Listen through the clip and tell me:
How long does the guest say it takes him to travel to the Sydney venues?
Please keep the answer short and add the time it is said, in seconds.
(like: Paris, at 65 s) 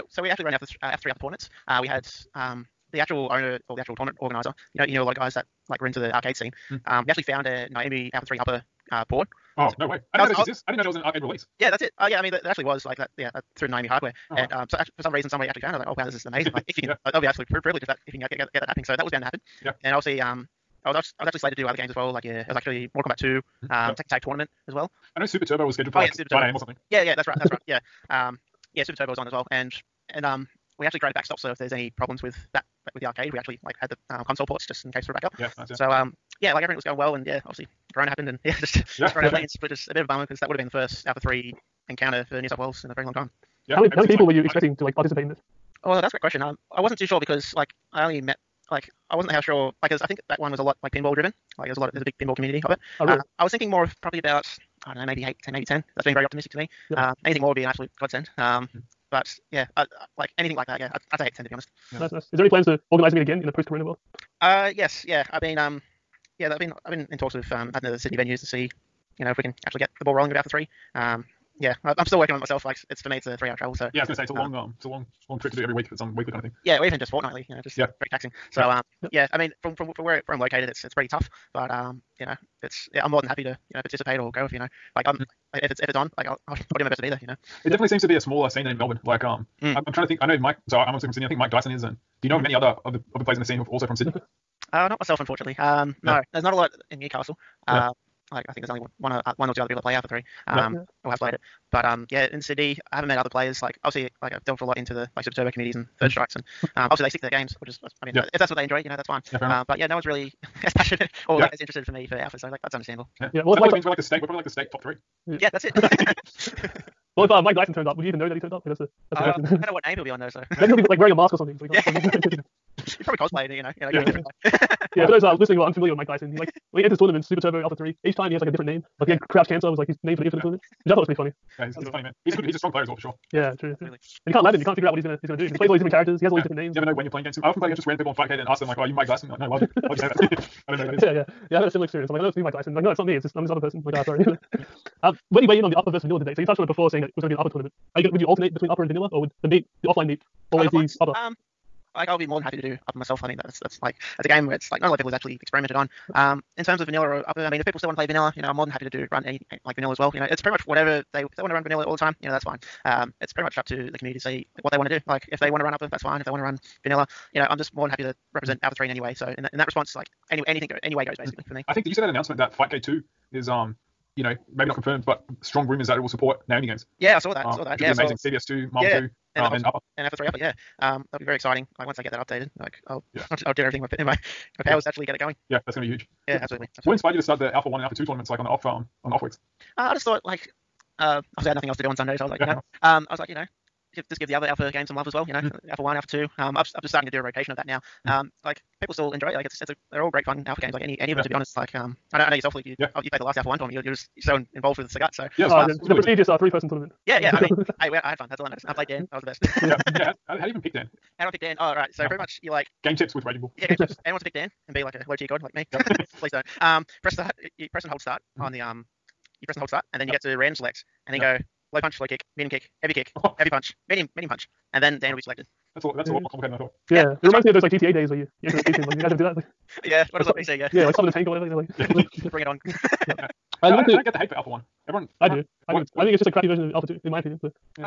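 3 hours, at 73 s.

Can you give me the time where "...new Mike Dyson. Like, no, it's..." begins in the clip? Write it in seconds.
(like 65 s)
142 s.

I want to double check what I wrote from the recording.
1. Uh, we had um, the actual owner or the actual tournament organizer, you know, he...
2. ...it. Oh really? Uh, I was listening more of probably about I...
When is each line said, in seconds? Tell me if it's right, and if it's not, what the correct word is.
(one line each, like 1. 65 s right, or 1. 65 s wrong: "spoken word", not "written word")
1. 1 s right
2. 52 s wrong: "thinking", not "listening".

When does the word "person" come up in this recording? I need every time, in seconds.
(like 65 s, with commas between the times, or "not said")
143 s, 206 s.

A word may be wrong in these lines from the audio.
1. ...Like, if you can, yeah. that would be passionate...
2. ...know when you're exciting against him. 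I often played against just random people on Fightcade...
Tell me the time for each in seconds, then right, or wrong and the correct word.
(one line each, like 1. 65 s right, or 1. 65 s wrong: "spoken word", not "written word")
1. 16 s wrong: "absolute", not "passionate"
2. 136 s wrong: "playing", not "exciting".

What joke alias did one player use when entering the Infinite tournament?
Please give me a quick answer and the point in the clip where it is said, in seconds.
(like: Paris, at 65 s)
Crouch Cancer, at 129 s.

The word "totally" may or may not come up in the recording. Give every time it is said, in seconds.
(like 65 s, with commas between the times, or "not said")
not said.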